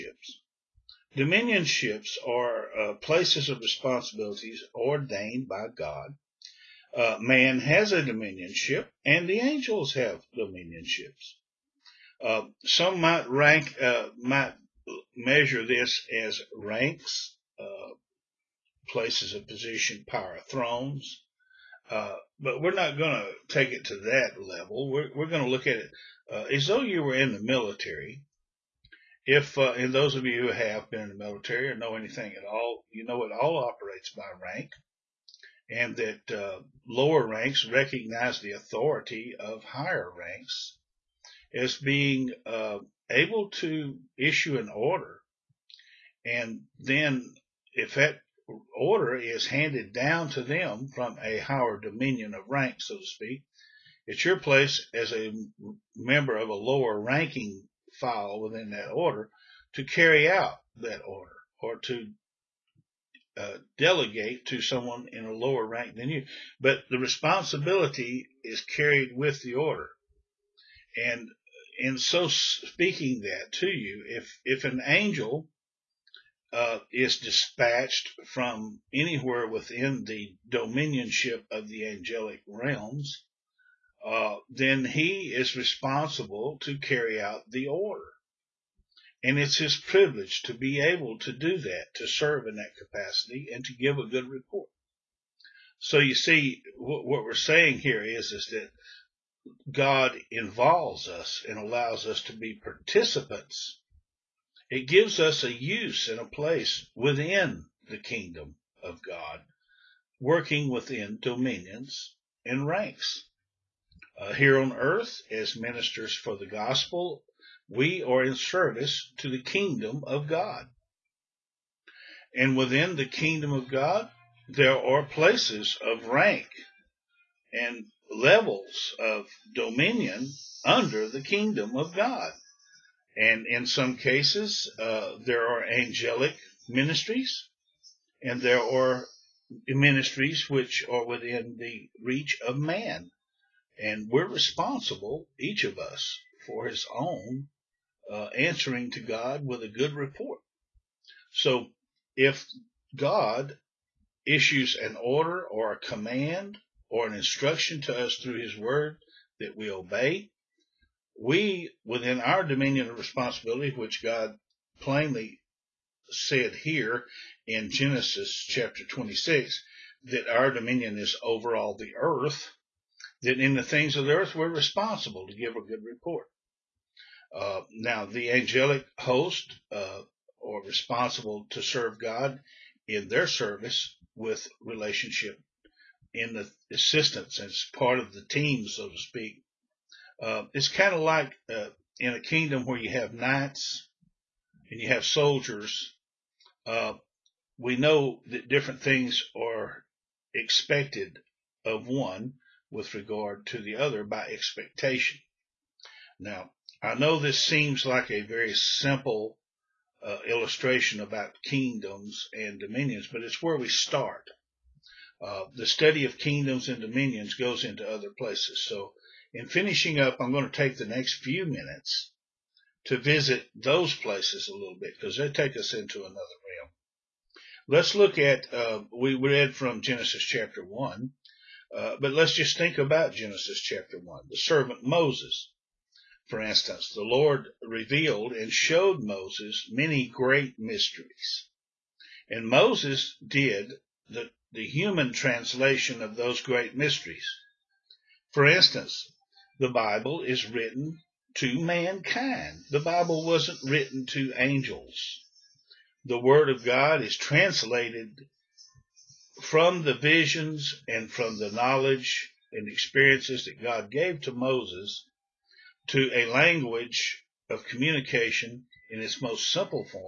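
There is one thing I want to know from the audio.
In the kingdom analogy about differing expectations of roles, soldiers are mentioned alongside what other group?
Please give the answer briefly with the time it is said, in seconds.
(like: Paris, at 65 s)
knights, at 193 s.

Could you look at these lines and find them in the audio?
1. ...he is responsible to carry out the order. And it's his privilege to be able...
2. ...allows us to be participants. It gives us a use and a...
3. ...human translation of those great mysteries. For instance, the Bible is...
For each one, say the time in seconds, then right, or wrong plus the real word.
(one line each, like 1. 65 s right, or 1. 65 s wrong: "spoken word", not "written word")
1. 84 s right
2. 101 s right
3. 244 s right.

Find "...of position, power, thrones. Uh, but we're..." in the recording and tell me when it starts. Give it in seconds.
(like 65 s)
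19 s.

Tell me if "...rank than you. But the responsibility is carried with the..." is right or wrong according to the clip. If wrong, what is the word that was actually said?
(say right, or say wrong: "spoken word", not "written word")
right.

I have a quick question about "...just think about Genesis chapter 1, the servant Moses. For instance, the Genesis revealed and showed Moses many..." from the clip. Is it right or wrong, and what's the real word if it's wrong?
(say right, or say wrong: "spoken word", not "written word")
wrong: "Lord", not "Genesis".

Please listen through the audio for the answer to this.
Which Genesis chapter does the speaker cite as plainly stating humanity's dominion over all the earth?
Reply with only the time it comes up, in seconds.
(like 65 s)
167 s.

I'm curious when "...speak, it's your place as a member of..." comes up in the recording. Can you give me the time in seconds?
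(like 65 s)
53 s.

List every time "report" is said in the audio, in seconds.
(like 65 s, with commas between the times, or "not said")
94 s, 149 s, 175 s.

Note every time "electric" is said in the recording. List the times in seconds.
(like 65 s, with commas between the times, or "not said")
not said.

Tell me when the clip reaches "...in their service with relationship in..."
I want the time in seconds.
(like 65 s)
182 s.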